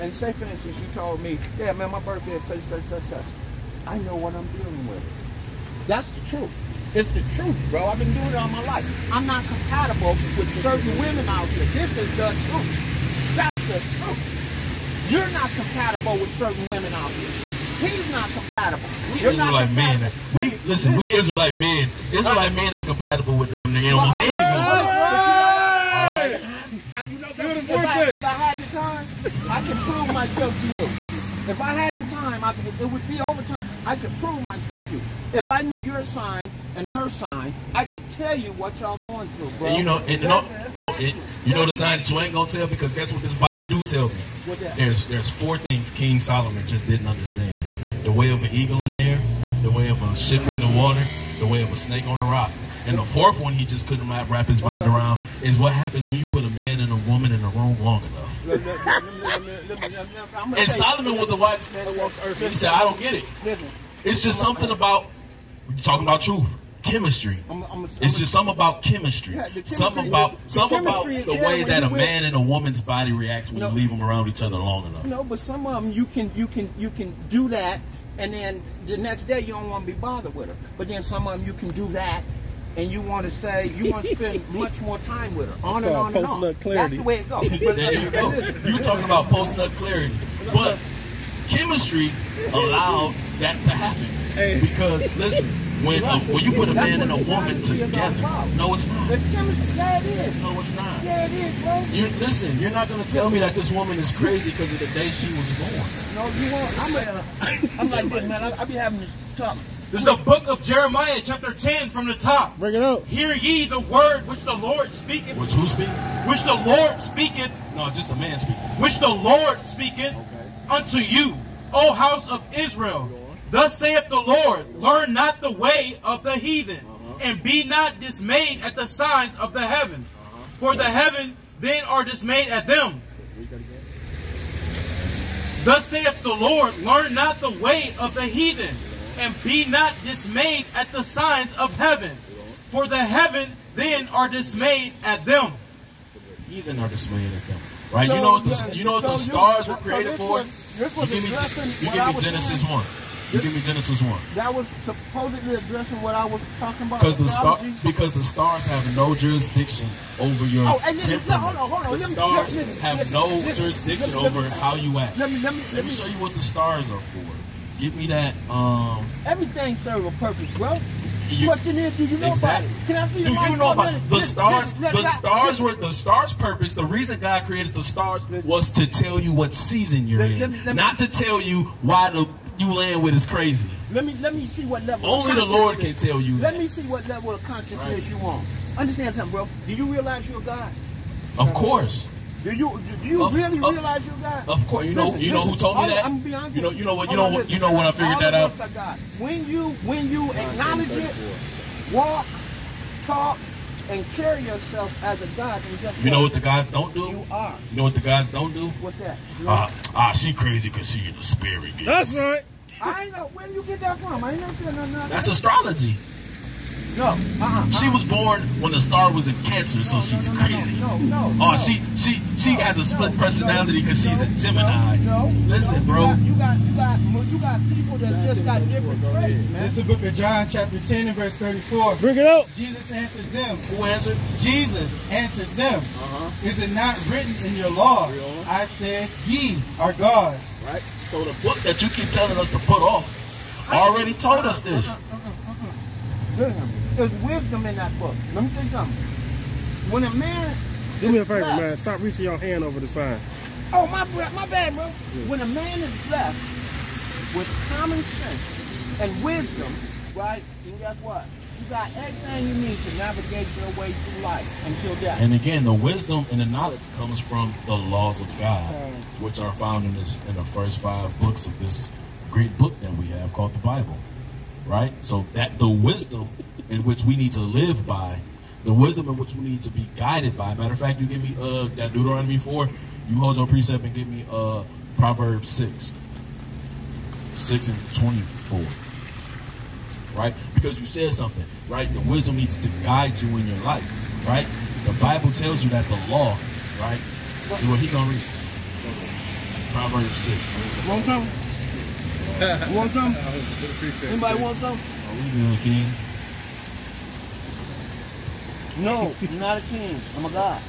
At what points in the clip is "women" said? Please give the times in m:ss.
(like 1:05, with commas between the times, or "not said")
0:10, 0:16.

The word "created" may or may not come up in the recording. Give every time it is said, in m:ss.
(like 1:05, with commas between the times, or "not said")
2:29, 2:57.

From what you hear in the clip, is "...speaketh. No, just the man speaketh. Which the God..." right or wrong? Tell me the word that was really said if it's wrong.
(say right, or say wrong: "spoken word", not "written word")
wrong: "Lord", not "God".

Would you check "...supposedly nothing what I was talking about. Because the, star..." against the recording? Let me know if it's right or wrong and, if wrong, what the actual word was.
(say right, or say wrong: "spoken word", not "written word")
wrong: "addressing", not "nothing".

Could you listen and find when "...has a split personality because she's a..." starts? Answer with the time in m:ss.
3:42.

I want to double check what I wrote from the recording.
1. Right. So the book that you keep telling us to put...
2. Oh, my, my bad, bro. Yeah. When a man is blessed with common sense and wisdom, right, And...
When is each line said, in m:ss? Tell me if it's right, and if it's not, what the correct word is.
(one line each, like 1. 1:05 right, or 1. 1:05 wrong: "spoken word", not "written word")
1. 4:00 right
2. 4:13 right.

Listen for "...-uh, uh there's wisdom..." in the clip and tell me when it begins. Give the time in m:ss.
4:06.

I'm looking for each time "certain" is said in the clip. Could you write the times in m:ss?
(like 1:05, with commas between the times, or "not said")
0:10, 0:16.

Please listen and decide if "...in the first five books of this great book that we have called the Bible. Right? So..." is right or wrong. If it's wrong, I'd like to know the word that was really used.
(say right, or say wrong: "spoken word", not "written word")
right.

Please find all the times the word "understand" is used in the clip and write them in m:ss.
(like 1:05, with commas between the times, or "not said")
0:47, 3:08.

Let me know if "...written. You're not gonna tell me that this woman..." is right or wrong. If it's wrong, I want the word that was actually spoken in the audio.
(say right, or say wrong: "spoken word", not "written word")
wrong: "listen", not "written".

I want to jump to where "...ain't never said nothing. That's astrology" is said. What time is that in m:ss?
3:34.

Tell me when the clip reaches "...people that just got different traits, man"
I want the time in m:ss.
3:47.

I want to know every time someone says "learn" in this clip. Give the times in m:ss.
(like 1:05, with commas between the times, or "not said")
2:04, 2:16.